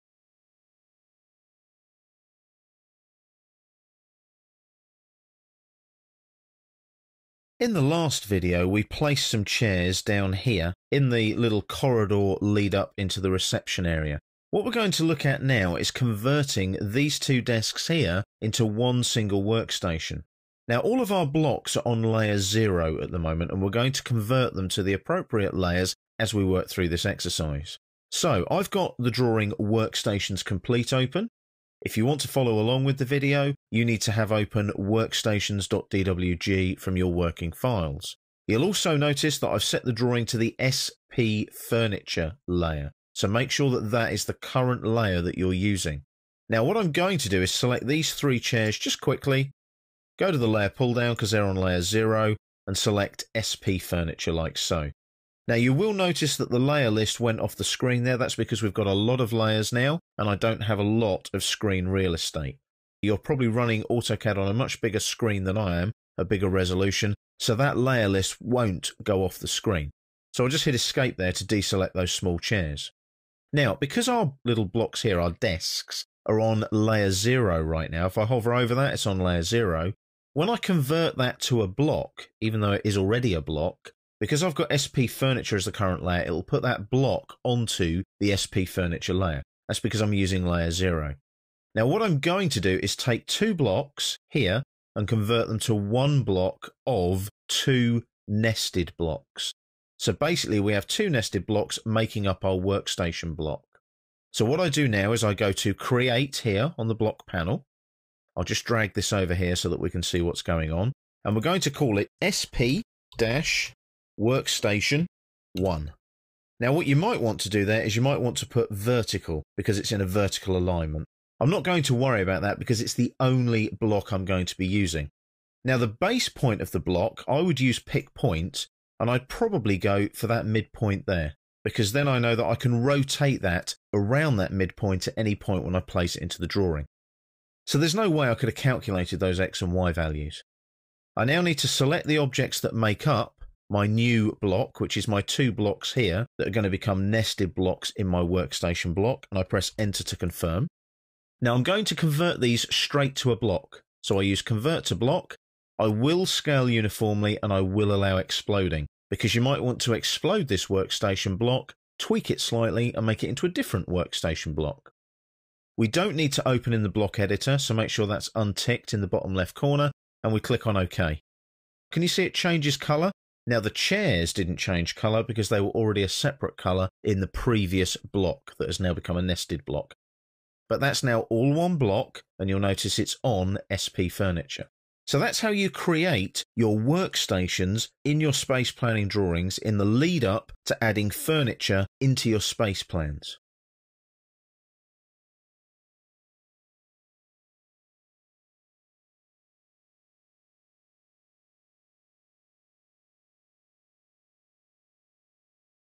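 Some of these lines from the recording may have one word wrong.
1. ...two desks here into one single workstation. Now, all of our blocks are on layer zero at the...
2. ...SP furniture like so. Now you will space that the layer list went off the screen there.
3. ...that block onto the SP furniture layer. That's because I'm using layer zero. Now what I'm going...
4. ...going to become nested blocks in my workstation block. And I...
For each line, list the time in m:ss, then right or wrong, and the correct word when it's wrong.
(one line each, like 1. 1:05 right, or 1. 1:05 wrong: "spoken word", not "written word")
1. 0:17 right
2. 0:53 wrong: "notice", not "space"
3. 1:26 right
4. 2:26 right.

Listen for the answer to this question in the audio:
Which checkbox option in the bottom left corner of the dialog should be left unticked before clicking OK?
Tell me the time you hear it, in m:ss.
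2:46.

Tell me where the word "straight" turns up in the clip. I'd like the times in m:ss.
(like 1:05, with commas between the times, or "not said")
2:32.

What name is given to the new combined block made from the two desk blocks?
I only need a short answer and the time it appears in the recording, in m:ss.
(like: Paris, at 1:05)
SP-workstation 1, at 1:52.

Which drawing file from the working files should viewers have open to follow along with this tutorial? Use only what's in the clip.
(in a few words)
workstations.dwg.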